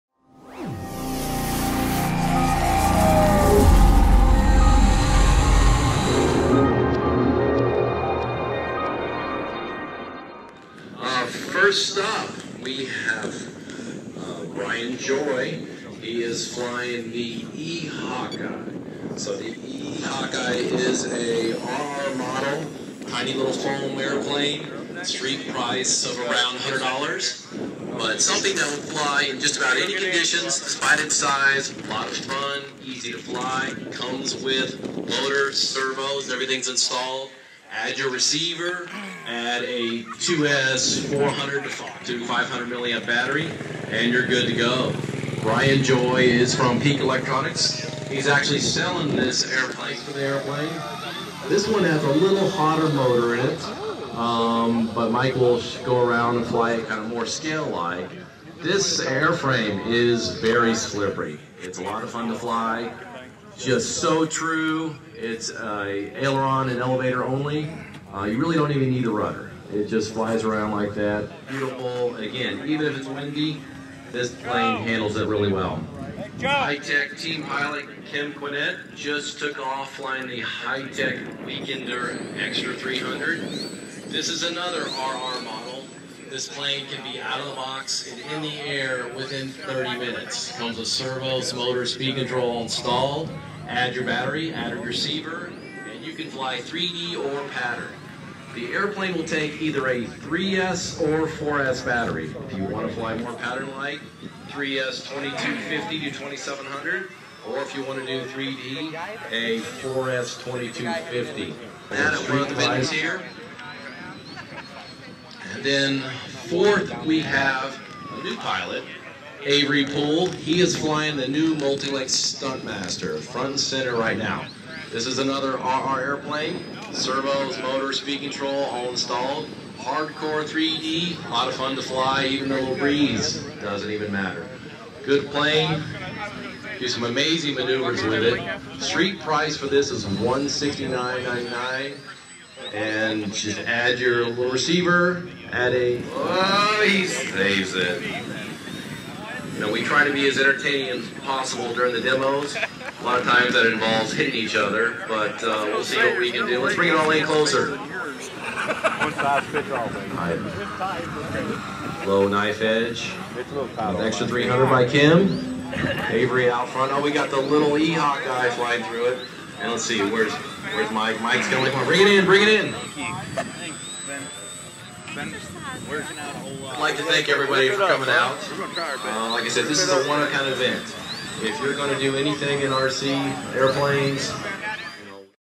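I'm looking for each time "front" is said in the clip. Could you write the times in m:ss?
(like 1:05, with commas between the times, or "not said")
2:03, 2:46.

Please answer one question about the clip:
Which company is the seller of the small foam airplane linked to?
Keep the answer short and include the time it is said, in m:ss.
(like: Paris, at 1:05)
Peak Electronics, at 0:46.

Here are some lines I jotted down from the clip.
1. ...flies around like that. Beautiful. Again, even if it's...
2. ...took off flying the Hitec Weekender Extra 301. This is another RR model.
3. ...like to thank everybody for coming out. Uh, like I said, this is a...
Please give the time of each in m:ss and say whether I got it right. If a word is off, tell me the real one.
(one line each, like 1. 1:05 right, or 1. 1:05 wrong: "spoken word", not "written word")
1. 1:10 right
2. 1:19 wrong: "300", not "301"
3. 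2:56 right.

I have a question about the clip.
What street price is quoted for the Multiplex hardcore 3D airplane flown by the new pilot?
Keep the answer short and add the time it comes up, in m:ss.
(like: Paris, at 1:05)
$169.99, at 2:20.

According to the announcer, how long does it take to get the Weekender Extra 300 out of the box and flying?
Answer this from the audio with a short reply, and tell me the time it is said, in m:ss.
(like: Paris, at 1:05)
30 minutes, at 1:29.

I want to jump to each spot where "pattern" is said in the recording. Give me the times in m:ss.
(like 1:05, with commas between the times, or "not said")
1:37, 1:43.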